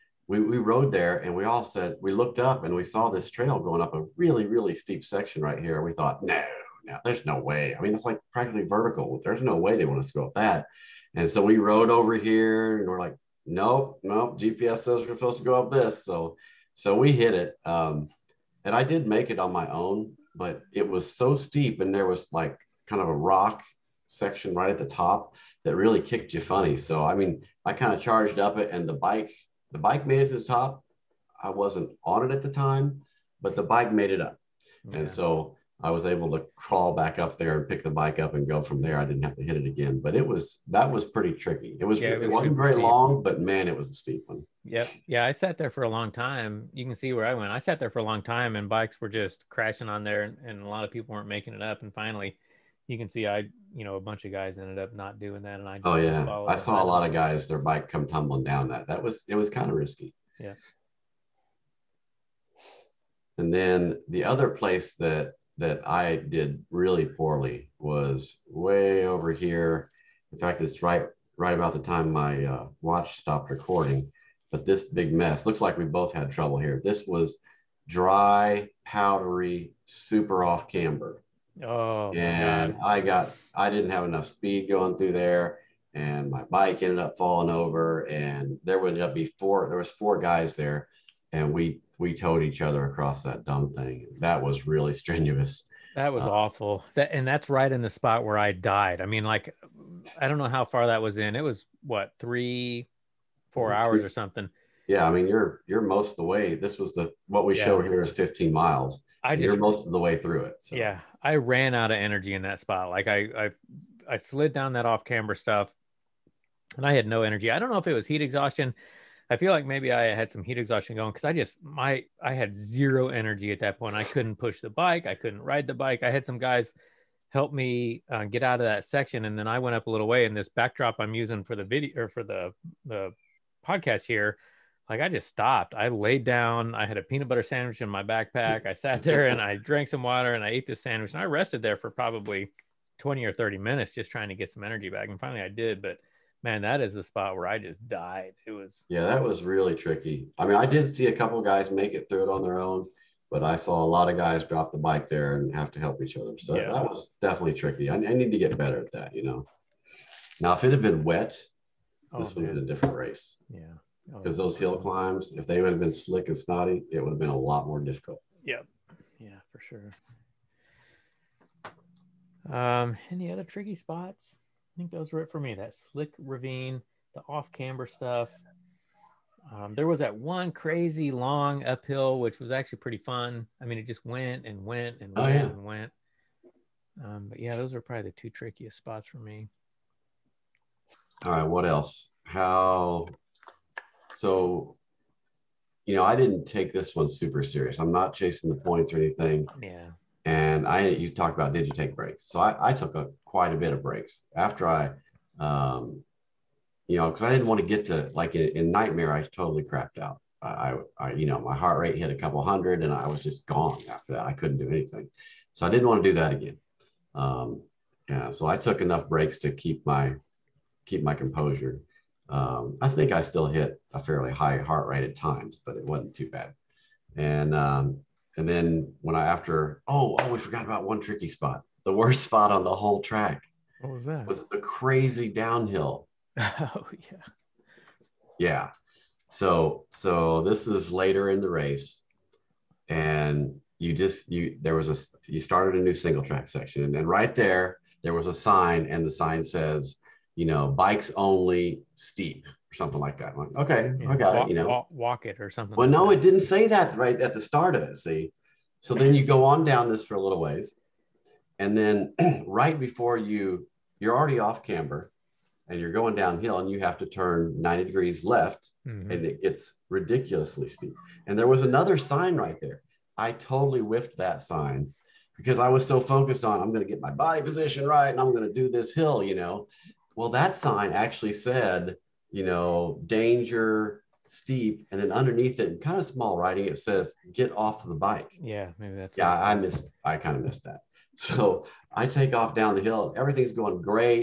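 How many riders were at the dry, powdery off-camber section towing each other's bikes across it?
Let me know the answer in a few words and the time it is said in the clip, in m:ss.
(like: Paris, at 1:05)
4, at 1:29.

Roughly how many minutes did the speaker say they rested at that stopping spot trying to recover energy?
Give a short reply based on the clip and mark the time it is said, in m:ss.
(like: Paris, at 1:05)
20 or 30 minutes, at 2:22.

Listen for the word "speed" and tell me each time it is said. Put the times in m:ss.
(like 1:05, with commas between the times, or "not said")
1:24.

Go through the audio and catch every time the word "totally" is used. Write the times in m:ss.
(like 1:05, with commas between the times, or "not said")
3:29, 4:33.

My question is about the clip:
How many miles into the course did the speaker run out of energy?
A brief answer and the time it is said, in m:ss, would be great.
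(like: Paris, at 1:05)
15 miles, at 1:48.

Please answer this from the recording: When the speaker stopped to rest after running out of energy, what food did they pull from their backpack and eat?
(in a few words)
peanut butter sandwich.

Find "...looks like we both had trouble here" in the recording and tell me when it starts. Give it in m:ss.
1:15.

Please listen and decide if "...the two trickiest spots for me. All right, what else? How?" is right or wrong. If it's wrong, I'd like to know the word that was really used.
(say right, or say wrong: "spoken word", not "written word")
right.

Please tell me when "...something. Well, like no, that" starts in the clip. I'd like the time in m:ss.
4:15.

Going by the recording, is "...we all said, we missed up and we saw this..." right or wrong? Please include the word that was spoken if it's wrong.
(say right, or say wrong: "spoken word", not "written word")
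wrong: "looked", not "missed".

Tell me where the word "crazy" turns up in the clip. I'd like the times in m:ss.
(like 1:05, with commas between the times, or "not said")
3:00, 3:54.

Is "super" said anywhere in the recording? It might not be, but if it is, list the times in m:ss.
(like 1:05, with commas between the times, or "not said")
1:19, 3:17.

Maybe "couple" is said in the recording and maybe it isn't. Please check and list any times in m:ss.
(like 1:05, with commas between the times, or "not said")
2:31, 3:32.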